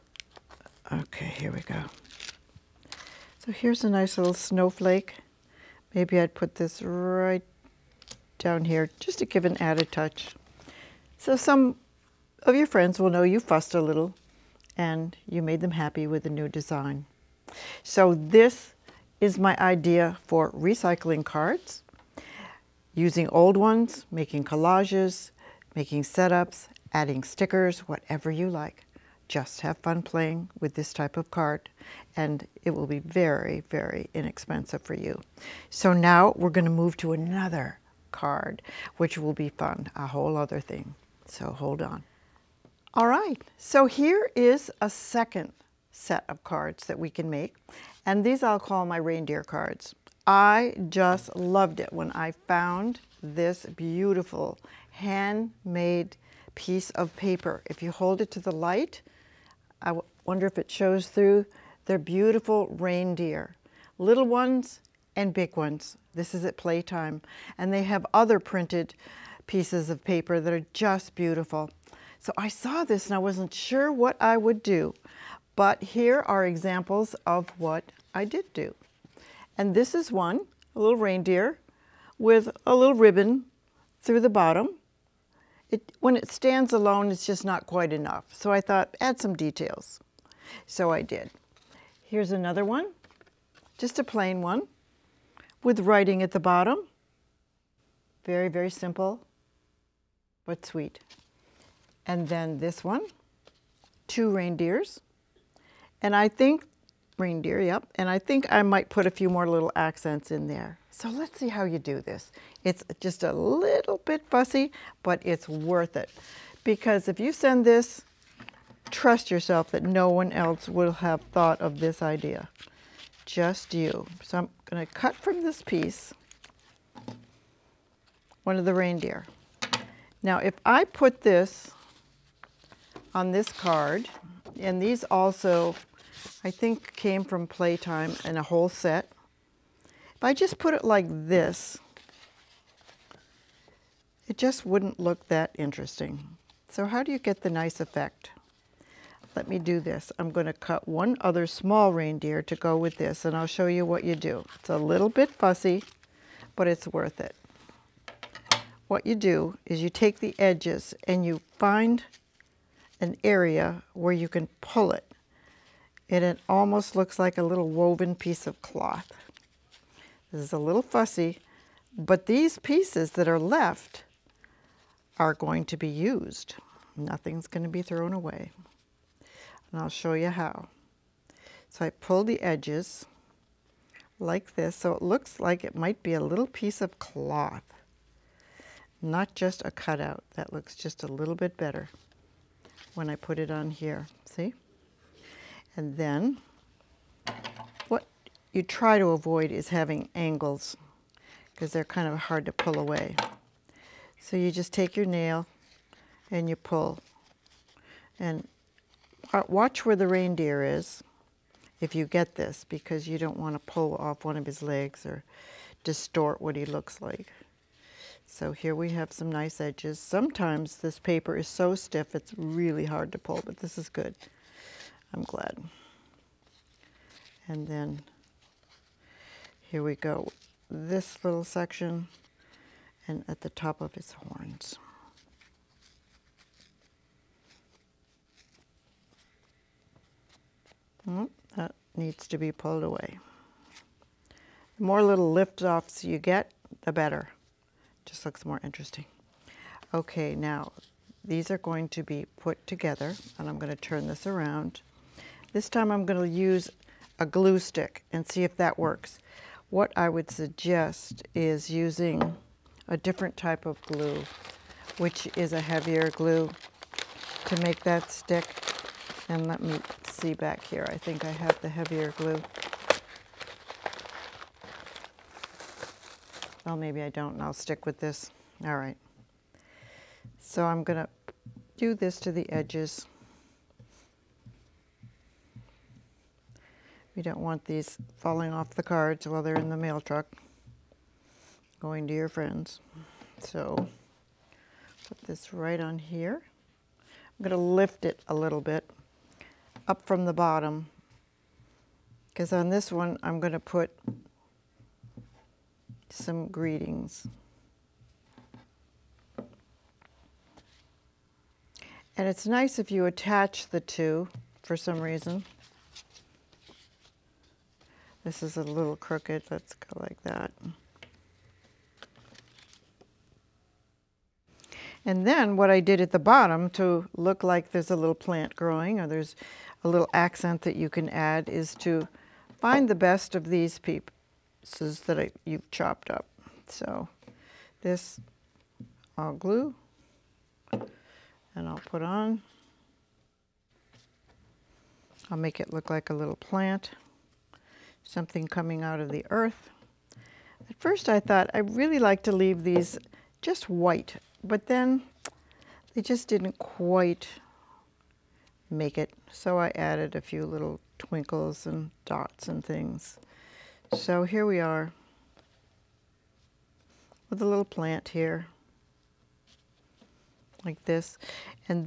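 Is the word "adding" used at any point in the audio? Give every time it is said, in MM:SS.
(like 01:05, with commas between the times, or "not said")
00:26.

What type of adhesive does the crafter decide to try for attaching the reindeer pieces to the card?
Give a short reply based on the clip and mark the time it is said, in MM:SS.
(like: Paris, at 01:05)
glue stick, at 04:15.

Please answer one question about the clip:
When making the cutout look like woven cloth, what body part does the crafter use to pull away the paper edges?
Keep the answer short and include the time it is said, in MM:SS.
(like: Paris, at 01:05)
nail, at 03:24.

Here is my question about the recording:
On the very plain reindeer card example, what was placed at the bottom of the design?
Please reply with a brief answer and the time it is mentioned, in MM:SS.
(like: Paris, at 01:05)
writing, at 01:35.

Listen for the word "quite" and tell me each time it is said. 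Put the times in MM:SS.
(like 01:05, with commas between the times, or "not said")
01:27, 05:56.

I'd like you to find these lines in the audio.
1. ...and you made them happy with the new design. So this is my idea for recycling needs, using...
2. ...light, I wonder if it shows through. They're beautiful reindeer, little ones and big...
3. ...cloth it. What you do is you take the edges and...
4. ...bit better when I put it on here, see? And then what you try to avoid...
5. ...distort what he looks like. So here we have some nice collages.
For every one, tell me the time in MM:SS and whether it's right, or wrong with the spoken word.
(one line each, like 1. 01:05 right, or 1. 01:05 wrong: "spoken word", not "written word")
1. 00:14 wrong: "cards", not "needs"
2. 00:58 right
3. 02:36 wrong: "worth", not "cloth"
4. 03:11 right
5. 03:35 wrong: "edges", not "collages".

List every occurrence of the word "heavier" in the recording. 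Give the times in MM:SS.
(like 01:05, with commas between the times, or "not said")
04:25, 04:31.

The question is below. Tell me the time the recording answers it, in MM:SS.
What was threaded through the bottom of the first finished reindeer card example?
01:22.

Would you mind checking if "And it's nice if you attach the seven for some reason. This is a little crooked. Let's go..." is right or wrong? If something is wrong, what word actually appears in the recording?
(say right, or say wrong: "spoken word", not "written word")
wrong: "two", not "seven".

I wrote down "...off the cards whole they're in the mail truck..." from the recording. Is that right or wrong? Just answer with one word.
wrong.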